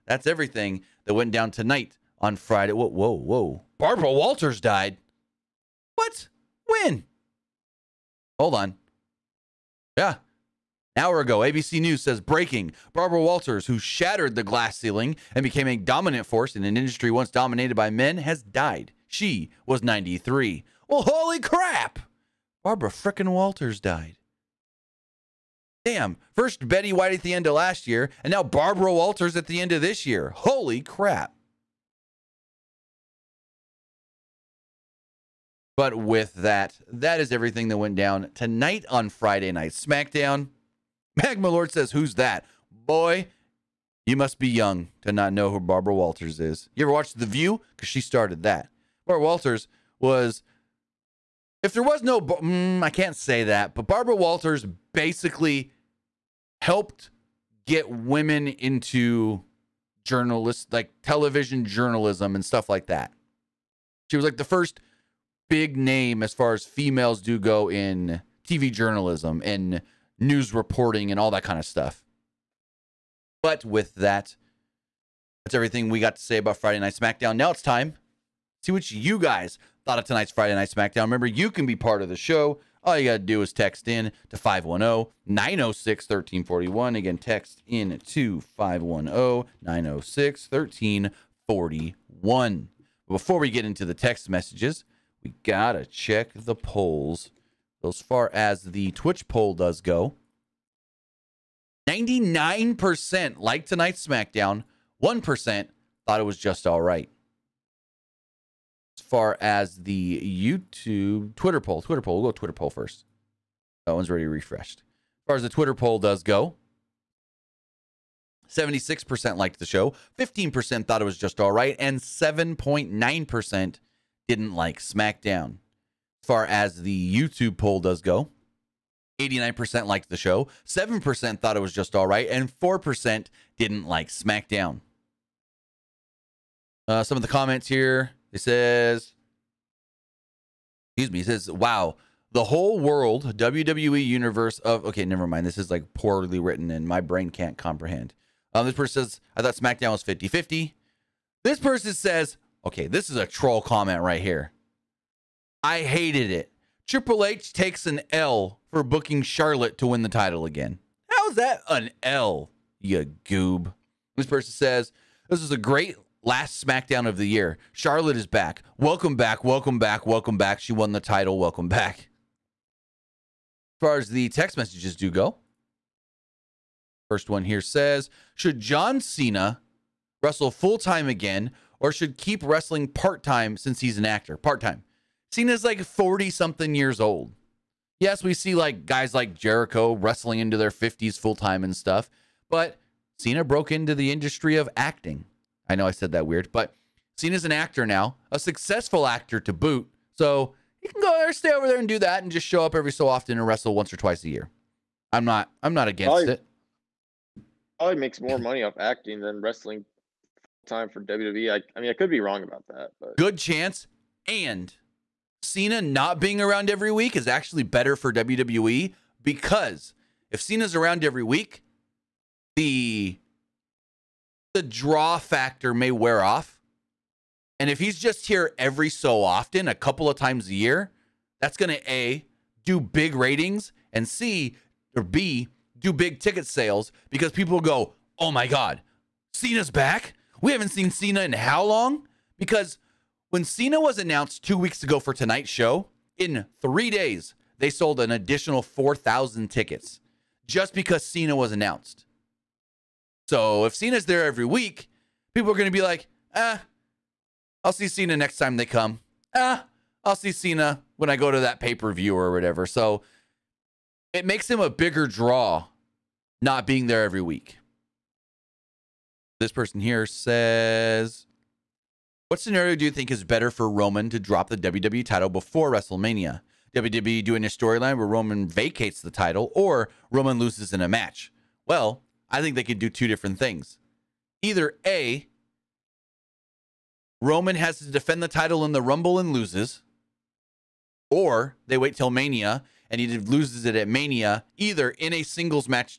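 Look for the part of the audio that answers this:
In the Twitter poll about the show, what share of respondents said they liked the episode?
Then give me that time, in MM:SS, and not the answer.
01:58.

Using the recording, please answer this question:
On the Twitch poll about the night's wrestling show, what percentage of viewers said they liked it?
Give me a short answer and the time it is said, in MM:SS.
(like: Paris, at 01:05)
99%, at 01:41.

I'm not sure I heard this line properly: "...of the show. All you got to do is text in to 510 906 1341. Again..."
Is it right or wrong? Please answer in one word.
right.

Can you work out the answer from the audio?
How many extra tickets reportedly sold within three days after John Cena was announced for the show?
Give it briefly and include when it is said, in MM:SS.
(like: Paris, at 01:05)
4,000, at 04:08.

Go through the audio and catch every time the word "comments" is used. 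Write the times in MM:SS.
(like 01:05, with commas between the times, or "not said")
02:17, 02:33.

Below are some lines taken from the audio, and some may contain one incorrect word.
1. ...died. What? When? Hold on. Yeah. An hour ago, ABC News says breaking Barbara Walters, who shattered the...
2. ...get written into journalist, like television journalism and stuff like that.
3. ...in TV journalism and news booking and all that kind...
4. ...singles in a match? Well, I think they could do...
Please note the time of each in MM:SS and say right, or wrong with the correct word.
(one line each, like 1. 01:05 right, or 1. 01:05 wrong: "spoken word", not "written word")
1. 00:04 right
2. 00:57 wrong: "women", not "written"
3. 01:07 wrong: "reporting", not "booking"
4. 04:40 wrong: "loses", not "singles".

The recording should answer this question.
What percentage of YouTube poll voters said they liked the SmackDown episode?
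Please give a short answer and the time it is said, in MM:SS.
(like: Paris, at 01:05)
89%, at 02:09.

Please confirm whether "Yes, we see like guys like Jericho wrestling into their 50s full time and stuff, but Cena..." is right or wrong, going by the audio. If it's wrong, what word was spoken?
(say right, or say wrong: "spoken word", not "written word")
right.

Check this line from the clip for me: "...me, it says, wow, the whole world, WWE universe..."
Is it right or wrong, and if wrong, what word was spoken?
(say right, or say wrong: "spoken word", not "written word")
right.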